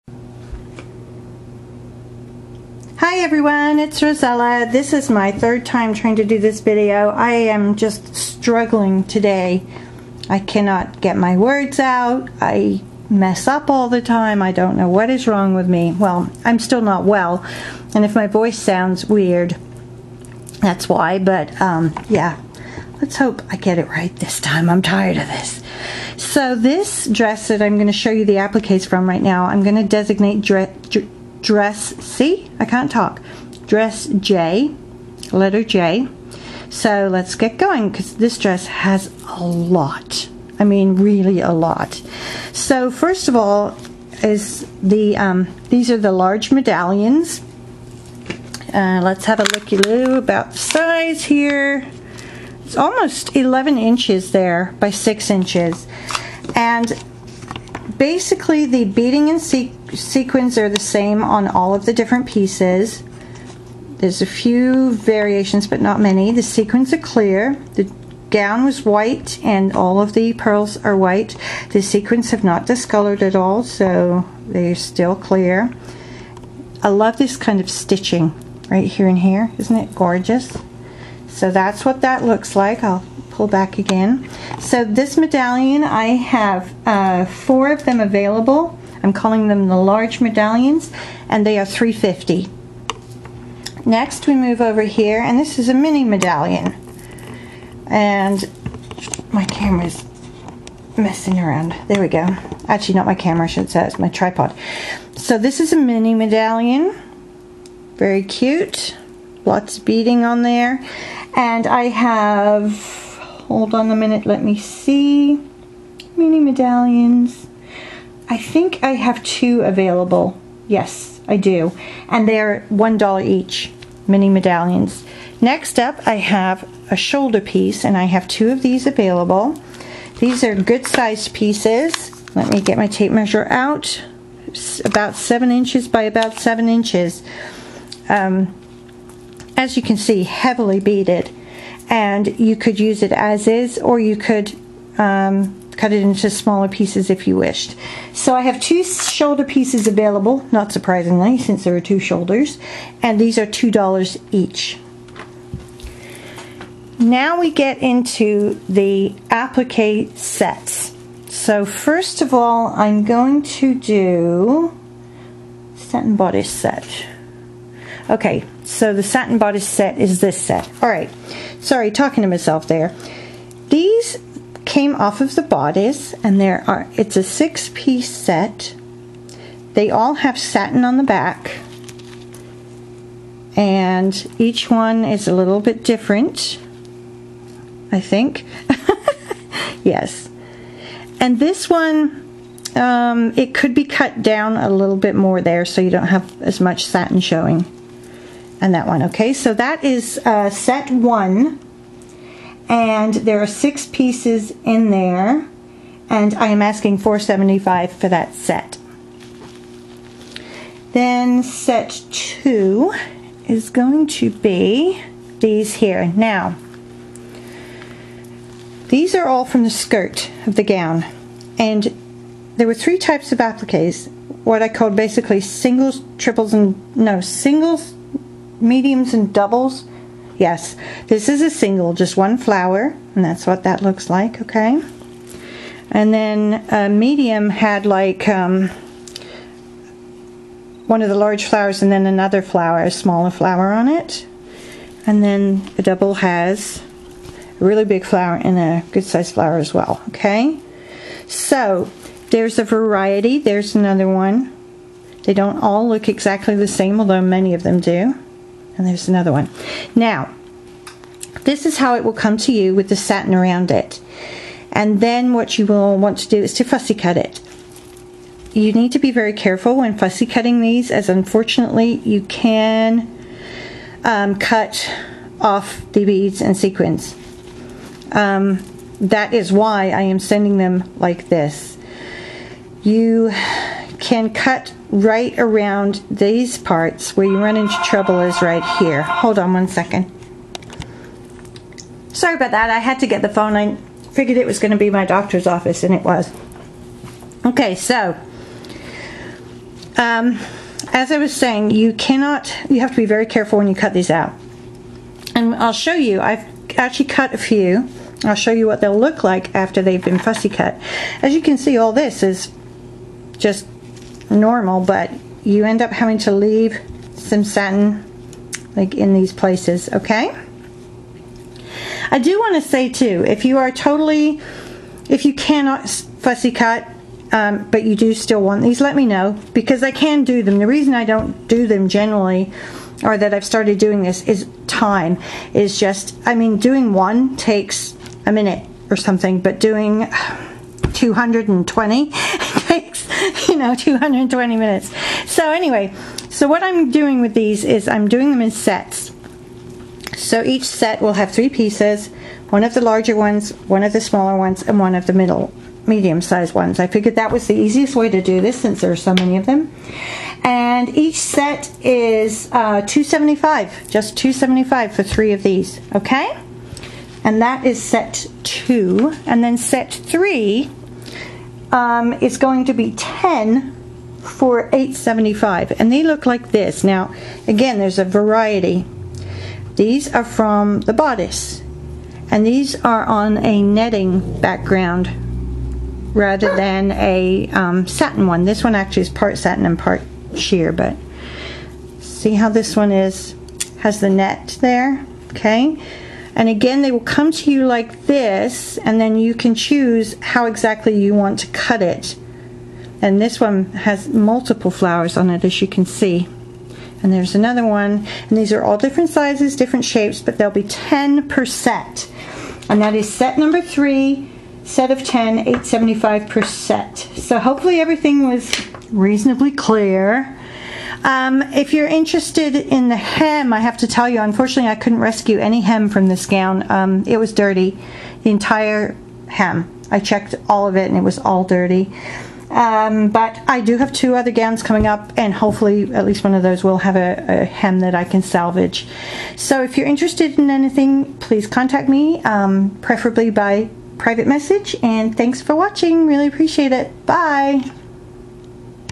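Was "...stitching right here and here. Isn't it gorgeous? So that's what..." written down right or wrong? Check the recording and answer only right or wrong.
right.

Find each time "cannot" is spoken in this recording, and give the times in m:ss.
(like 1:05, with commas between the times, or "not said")
0:10, 5:01, 5:25.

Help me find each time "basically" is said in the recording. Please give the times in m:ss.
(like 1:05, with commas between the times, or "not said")
0:58, 3:44.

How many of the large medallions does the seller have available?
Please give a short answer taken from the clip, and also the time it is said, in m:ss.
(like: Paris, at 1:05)
4, at 1:27.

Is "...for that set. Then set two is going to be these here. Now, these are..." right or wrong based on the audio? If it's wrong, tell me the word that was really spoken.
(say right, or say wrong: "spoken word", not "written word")
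right.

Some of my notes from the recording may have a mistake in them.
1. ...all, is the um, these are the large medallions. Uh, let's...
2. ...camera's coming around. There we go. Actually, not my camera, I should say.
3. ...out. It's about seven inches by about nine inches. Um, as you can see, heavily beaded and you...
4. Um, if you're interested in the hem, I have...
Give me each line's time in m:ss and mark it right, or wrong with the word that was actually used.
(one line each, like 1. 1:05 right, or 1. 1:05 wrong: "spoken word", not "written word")
1. 0:43 right
2. 1:39 wrong: "messing", not "coming"
3. 2:13 wrong: "seven", not "nine"
4. 7:01 right.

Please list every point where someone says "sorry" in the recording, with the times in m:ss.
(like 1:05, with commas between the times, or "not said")
2:51, 4:52.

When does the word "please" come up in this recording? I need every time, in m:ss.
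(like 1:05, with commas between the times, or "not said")
7:21.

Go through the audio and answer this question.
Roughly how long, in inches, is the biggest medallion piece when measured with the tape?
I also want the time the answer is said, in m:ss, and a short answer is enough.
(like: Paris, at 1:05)
11 inches, at 0:53.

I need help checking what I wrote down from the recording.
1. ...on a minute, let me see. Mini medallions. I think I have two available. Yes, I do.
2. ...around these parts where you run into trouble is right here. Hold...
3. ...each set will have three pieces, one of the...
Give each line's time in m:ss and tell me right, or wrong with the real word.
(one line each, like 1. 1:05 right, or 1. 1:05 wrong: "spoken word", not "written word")
1. 1:53 right
2. 4:45 right
3. 5:50 right.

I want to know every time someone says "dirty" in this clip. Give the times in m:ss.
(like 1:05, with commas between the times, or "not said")
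7:07, 7:11.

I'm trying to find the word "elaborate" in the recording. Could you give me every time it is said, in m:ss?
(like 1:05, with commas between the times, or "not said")
not said.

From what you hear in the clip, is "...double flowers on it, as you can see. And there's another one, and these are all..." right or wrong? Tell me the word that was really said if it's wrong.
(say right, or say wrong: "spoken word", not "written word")
wrong: "multiple", not "double".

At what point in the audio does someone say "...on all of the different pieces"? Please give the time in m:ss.
1:01.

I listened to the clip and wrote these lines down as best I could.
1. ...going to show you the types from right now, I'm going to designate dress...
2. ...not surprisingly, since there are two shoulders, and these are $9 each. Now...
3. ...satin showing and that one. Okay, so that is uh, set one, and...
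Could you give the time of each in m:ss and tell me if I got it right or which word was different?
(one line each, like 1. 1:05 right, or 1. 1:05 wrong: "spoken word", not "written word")
1. 0:27 wrong: "appliques", not "types"
2. 2:30 wrong: "2", not "9"
3. 3:16 right.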